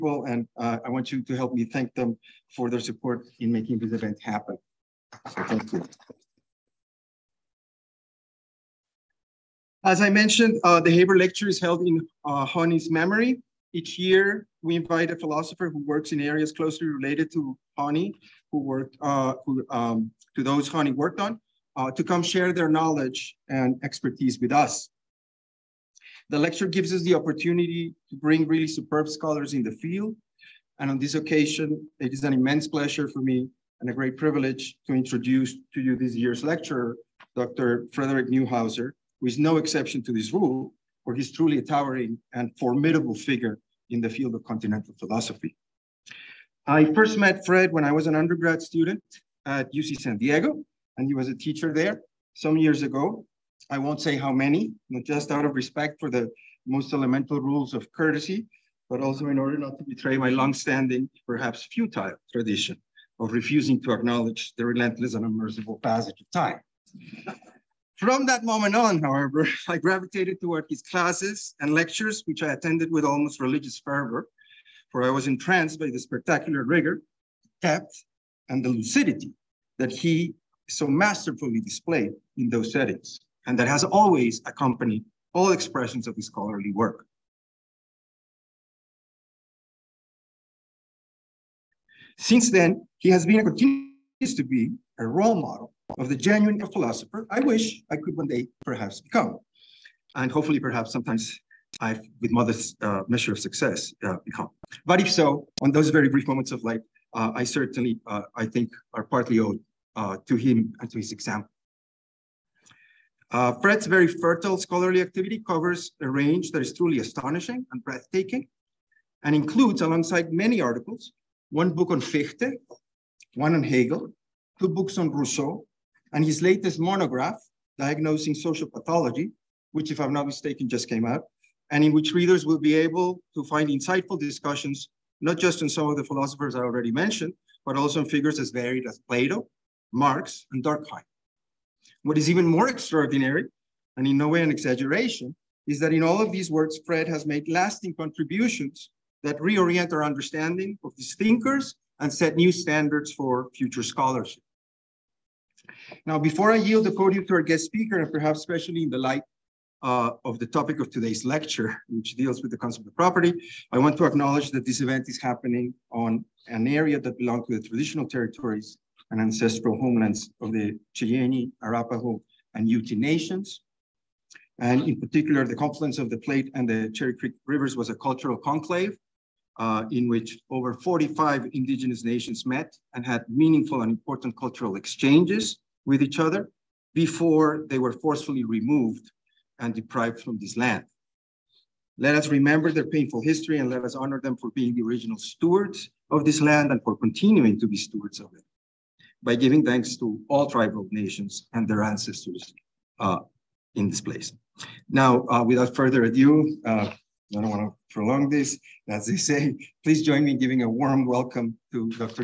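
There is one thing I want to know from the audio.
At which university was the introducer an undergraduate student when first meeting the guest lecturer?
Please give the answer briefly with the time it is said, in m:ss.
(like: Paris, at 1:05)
UC San Diego, at 0:49.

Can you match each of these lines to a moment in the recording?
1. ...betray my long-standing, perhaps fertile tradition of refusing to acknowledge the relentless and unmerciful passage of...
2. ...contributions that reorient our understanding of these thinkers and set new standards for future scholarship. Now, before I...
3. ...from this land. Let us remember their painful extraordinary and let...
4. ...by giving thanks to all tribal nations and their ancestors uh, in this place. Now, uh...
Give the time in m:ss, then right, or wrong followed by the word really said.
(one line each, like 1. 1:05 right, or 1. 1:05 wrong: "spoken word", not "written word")
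1. 0:59 wrong: "futile", not "fertile"
2. 2:27 right
3. 3:10 wrong: "history", not "extraordinary"
4. 3:19 right.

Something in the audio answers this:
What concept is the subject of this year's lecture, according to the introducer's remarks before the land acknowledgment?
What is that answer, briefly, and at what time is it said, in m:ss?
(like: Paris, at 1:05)
Property, at 2:42.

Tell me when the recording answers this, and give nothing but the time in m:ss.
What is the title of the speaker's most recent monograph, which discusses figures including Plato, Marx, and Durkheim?
2:07.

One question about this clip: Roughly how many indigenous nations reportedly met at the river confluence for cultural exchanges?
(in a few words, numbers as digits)
Over 45.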